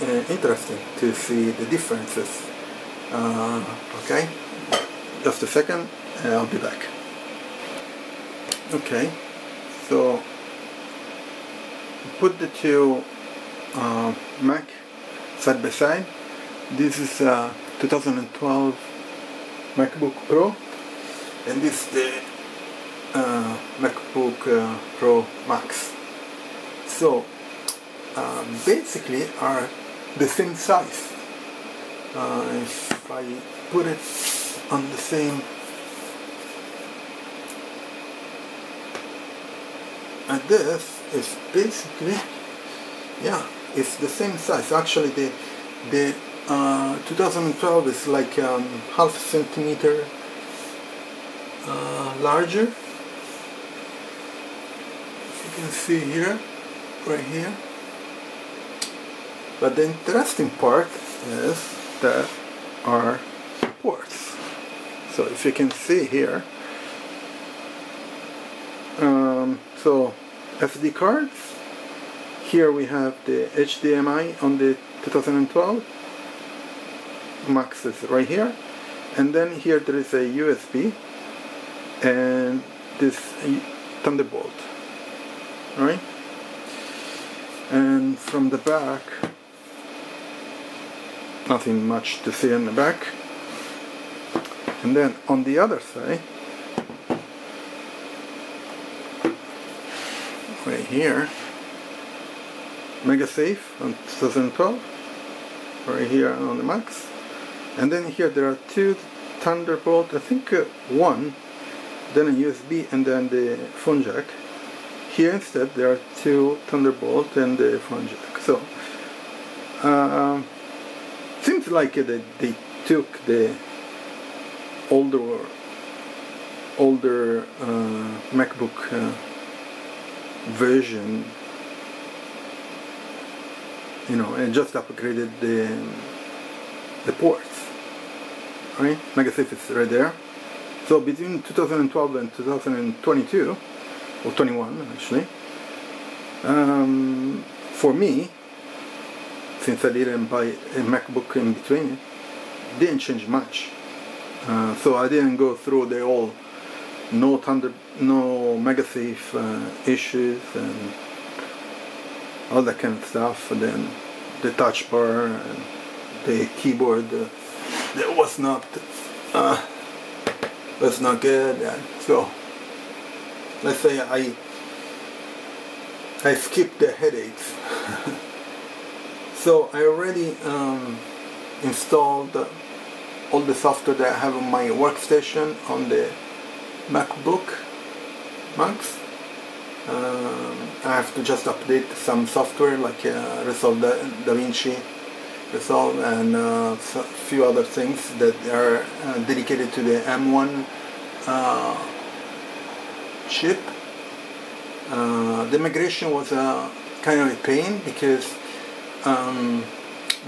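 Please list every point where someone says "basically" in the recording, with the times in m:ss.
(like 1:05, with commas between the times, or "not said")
0:28, 0:41.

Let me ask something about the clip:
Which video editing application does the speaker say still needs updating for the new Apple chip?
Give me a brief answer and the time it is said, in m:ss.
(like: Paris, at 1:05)
DaVinci Resolve, at 3:14.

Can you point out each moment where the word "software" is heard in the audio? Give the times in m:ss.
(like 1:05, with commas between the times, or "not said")
3:03, 3:12.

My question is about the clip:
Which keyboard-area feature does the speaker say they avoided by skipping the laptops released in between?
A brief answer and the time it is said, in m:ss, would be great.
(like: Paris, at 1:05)
touch bar, at 2:44.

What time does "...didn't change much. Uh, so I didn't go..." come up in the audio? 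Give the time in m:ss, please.
2:32.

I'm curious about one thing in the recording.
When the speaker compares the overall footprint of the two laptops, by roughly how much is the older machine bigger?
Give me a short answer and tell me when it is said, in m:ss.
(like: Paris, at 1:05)
half centimeter, at 0:48.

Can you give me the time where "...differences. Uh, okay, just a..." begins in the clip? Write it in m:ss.
0:01.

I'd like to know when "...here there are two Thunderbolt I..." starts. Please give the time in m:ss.
1:48.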